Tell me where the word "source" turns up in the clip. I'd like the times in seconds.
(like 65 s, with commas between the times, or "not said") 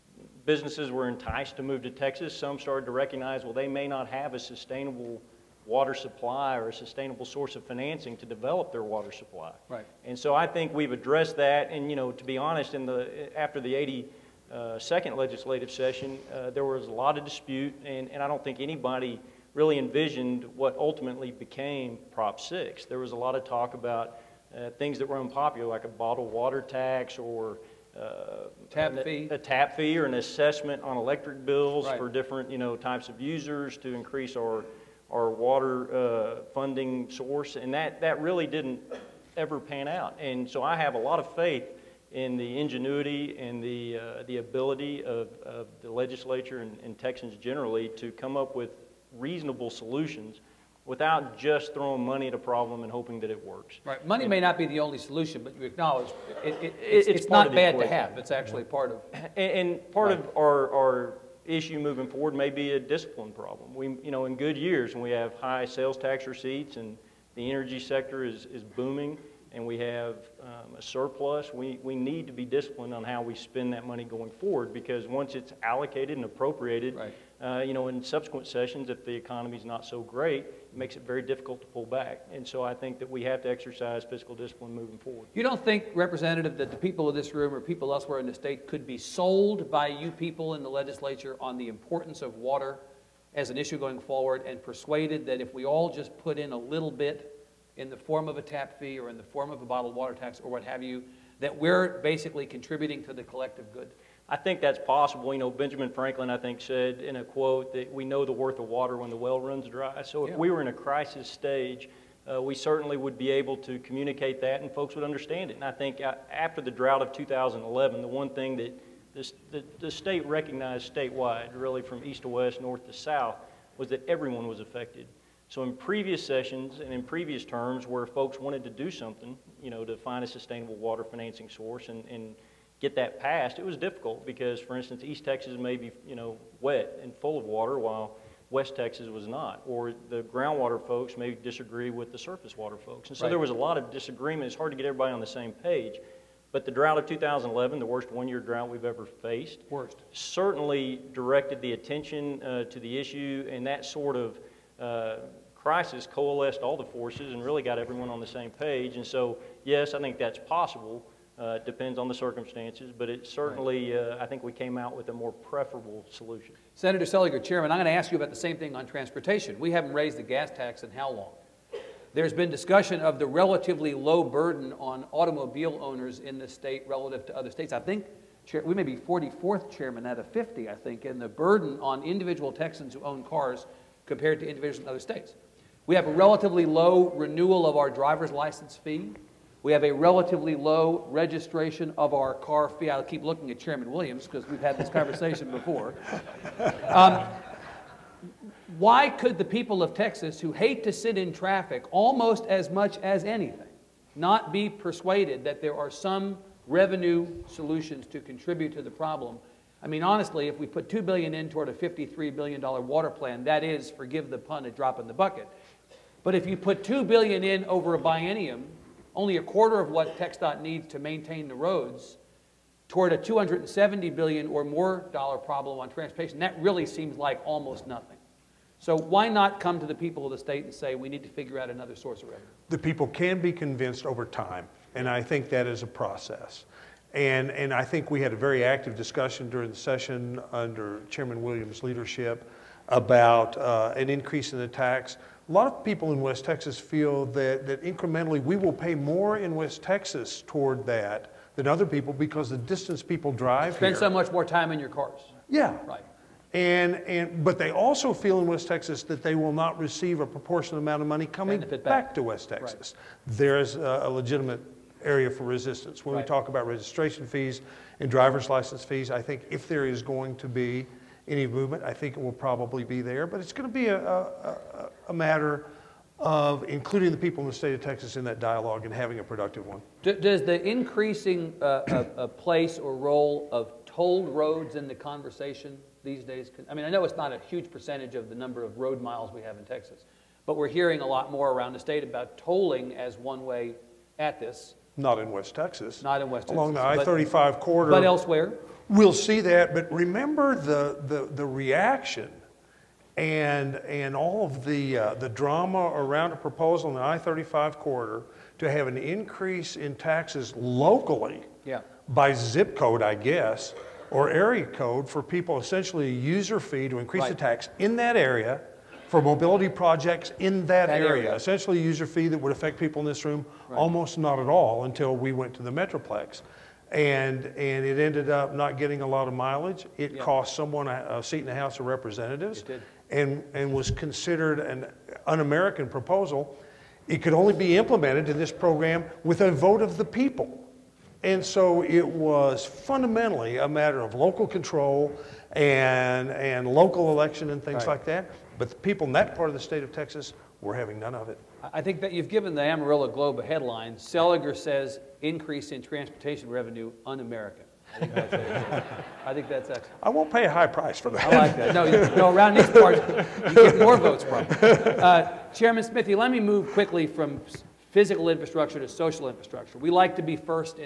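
7 s, 37 s, 131 s, 231 s.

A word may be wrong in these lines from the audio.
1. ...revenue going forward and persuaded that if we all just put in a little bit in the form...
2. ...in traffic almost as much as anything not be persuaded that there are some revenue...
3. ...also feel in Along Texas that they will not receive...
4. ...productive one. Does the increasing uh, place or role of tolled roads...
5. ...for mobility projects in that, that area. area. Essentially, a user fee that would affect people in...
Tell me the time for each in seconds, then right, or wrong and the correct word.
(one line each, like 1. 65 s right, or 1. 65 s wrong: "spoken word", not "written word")
1. 93 s wrong: "issue", not "revenue"
2. 201 s right
3. 257 s wrong: "West", not "Along"
4. 279 s right
5. 319 s right.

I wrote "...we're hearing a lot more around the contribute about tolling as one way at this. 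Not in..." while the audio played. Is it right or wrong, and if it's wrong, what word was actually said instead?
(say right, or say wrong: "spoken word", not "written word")
wrong: "state", not "contribute".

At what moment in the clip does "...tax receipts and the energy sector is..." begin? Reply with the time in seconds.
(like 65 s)
65 s.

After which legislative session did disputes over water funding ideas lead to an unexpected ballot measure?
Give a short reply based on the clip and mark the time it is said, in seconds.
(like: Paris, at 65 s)
82nd, at 14 s.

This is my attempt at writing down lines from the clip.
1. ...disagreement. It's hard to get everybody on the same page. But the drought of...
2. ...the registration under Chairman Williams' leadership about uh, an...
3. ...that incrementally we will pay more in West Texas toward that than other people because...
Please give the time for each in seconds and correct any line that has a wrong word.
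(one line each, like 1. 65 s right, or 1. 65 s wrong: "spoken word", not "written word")
1. 143 s right
2. 239 s wrong: "session", not "registration"
3. 247 s right.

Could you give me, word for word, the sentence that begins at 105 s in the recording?
You know, Benjamin Franklin, I think, said in a quote that we know the worth of water when the well runs dry.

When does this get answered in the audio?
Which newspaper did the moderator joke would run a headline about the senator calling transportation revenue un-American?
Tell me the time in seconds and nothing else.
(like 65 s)
352 s.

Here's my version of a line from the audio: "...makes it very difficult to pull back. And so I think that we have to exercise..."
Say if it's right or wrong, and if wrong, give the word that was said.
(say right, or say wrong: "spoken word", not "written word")
right.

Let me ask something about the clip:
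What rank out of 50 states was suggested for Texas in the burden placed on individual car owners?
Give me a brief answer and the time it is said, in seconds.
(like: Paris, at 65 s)
44th, at 178 s.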